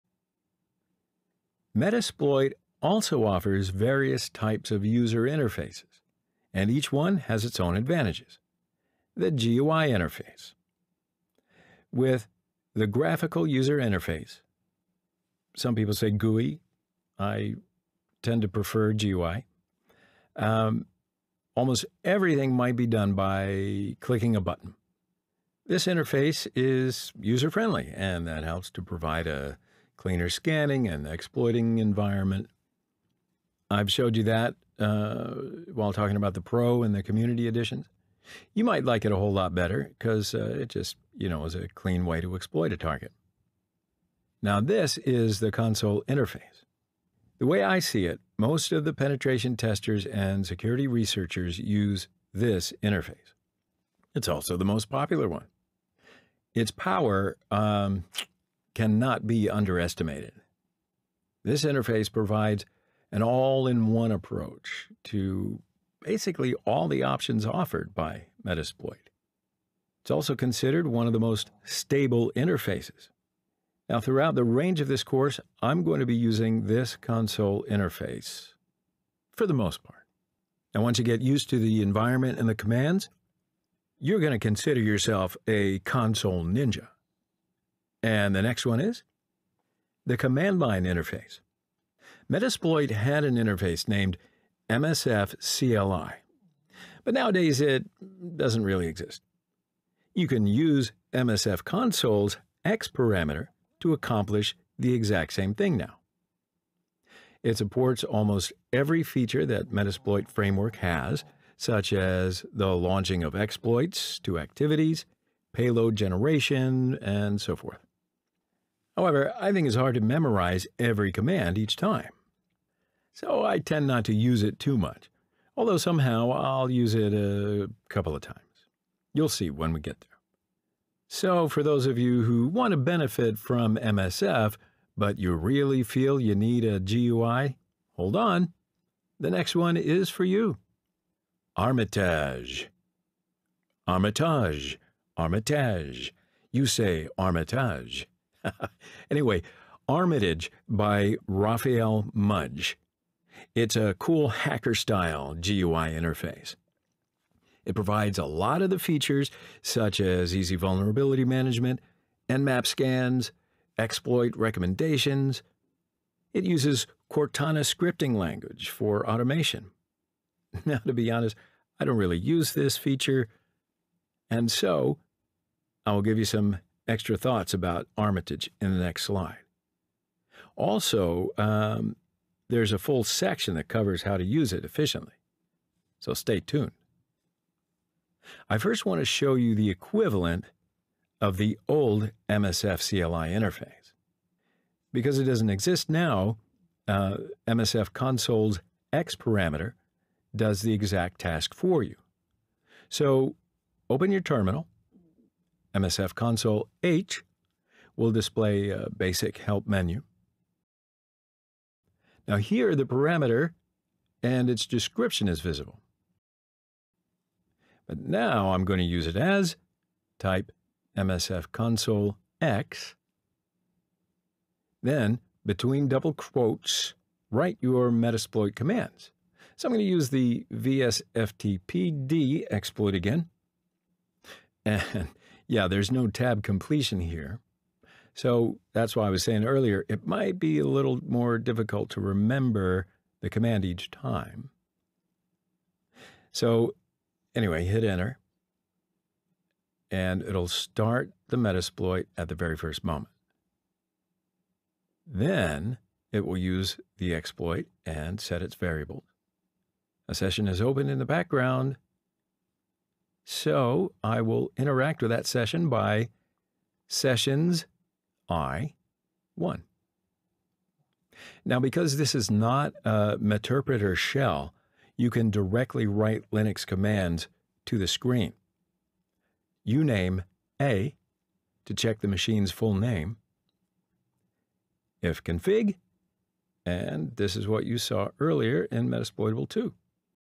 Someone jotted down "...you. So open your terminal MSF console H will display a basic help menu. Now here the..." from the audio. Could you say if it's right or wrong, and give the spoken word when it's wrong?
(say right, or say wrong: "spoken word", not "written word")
right.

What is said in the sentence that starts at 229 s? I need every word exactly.
So I'm going to use the vsftpd exploit again.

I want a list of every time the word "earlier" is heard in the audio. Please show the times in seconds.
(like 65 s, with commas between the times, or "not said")
239 s, 288 s.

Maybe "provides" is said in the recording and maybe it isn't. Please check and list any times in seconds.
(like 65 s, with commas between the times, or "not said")
28 s, 62 s, 157 s.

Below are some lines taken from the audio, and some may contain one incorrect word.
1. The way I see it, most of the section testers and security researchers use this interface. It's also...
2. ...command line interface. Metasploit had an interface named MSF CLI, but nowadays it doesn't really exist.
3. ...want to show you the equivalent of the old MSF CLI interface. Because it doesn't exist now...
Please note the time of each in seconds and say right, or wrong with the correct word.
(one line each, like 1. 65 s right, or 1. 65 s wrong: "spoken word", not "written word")
1. 47 s wrong: "penetration", not "section"
2. 90 s right
3. 188 s right.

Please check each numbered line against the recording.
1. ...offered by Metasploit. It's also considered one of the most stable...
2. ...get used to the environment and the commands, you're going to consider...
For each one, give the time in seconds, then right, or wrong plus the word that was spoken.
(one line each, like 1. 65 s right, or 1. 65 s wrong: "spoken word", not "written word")
1. 67 s right
2. 81 s right.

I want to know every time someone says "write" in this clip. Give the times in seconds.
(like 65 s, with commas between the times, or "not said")
227 s, 275 s.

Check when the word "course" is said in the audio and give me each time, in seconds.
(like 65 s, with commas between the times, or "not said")
75 s.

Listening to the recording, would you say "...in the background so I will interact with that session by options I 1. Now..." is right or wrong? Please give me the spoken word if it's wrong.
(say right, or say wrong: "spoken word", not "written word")
wrong: "sessions", not "options".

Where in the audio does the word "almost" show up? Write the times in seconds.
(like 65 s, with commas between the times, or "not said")
21 s, 108 s.